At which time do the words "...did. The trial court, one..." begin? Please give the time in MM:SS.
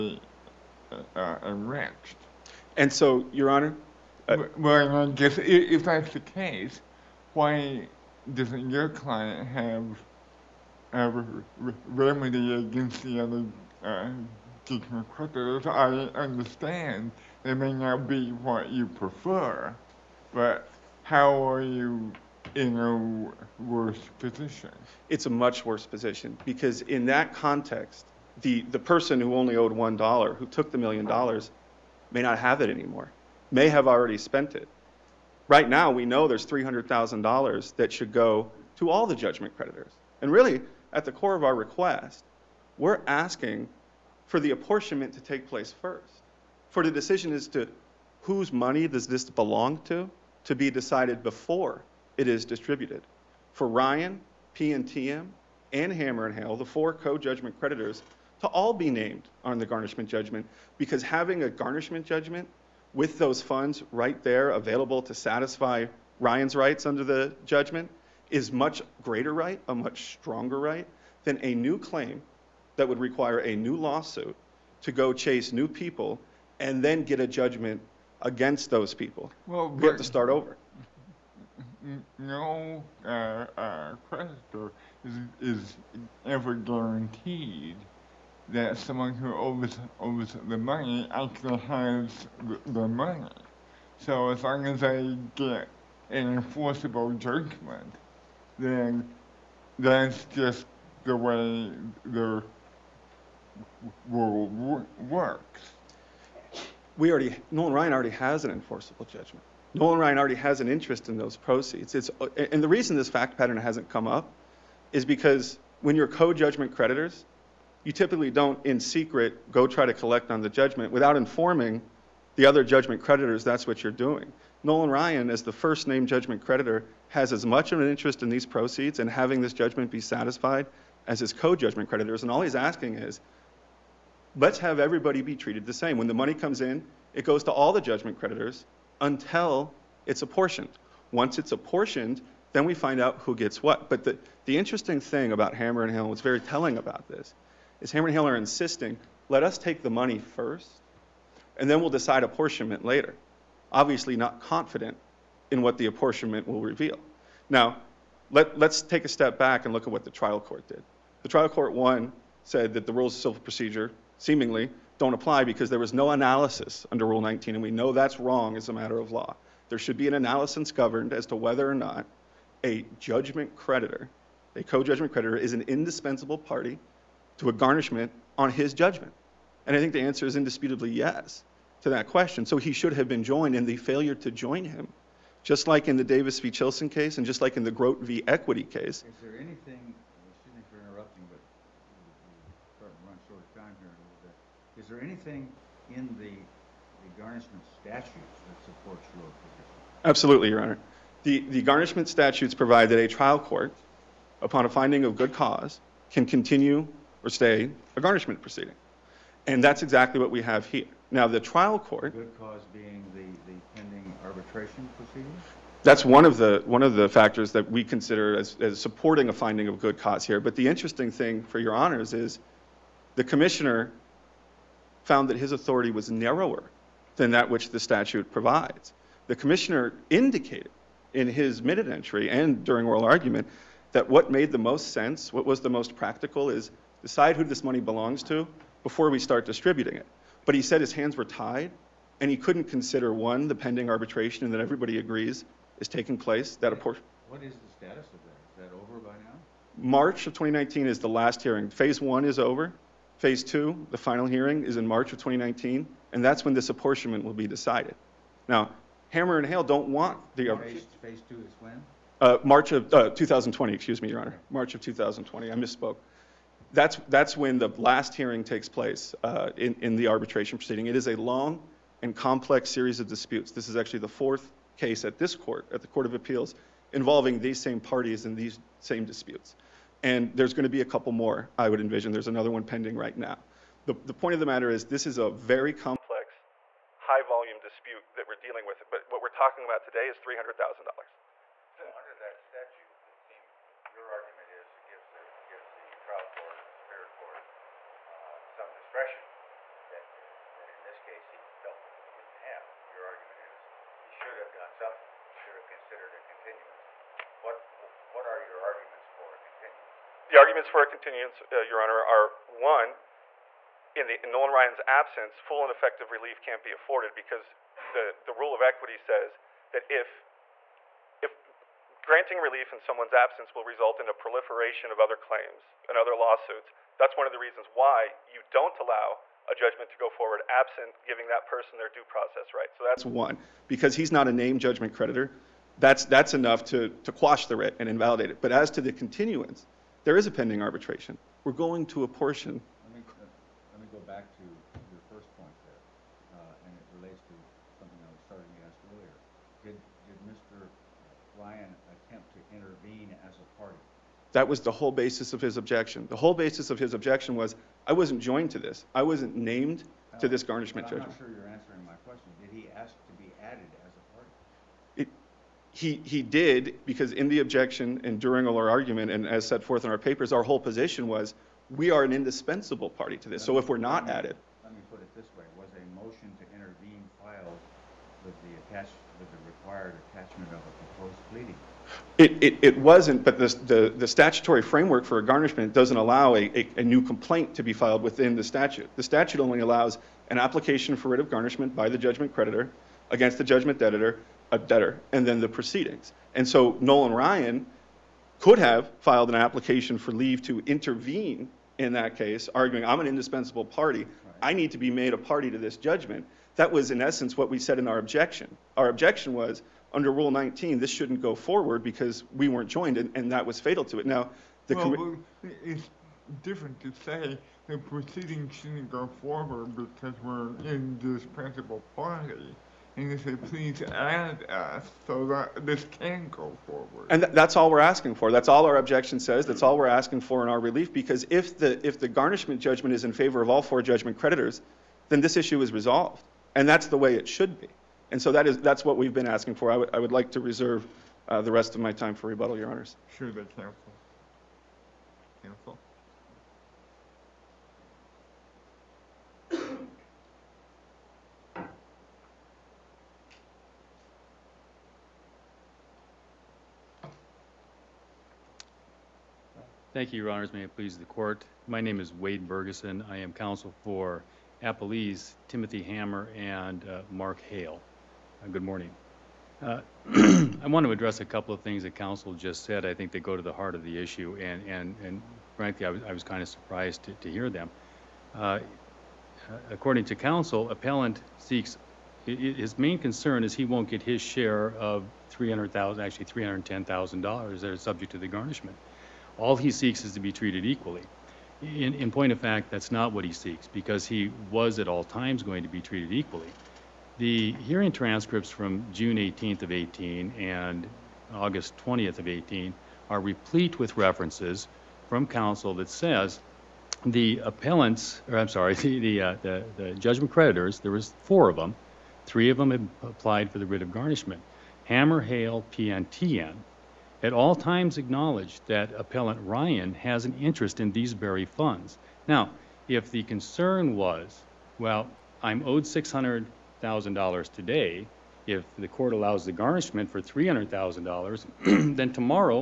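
02:40.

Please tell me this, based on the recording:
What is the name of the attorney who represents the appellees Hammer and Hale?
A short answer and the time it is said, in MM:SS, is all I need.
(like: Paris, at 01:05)
Wade Bergeson, at 07:42.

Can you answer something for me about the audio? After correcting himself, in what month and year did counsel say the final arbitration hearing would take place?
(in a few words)
March 2020.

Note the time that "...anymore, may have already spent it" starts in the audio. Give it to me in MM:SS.
00:32.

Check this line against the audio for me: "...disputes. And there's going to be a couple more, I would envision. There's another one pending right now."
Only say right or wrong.
right.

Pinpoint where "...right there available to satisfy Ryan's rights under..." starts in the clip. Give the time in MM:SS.
01:03.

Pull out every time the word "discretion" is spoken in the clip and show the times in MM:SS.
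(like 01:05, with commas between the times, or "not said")
04:58.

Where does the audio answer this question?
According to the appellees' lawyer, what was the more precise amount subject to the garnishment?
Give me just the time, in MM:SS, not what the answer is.
08:06.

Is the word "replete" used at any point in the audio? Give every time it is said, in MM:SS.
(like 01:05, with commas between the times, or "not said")
08:23.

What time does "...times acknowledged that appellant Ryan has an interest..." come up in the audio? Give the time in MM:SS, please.
08:37.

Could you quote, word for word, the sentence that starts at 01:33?
So as long as I get an enforceable judgment, then that's just the way the world works.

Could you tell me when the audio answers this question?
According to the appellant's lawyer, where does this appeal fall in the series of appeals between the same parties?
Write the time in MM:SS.
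04:34.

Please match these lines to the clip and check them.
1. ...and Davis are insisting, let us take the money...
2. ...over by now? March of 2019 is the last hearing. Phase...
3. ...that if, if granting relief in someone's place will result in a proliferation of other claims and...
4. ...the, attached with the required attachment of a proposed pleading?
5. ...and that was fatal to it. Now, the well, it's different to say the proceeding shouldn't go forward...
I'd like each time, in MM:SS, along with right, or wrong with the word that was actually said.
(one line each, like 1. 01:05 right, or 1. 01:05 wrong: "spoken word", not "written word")
1. 02:28 wrong: "Hill", not "Davis"
2. 04:08 right
3. 05:19 wrong: "absence", not "place"
4. 06:18 right
5. 06:53 right.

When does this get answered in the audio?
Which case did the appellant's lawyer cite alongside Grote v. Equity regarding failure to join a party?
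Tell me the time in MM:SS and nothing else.
03:06.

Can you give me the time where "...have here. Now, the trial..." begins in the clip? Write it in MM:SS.
03:30.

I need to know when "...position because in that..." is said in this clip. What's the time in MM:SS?
00:25.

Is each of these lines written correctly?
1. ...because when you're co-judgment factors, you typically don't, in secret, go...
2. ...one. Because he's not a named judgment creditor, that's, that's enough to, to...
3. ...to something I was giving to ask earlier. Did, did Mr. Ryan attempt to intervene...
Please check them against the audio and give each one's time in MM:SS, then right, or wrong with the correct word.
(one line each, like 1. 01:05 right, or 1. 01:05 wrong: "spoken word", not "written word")
1. 01:55 wrong: "creditors", not "factors"
2. 05:33 right
3. 05:47 wrong: "starting", not "giving".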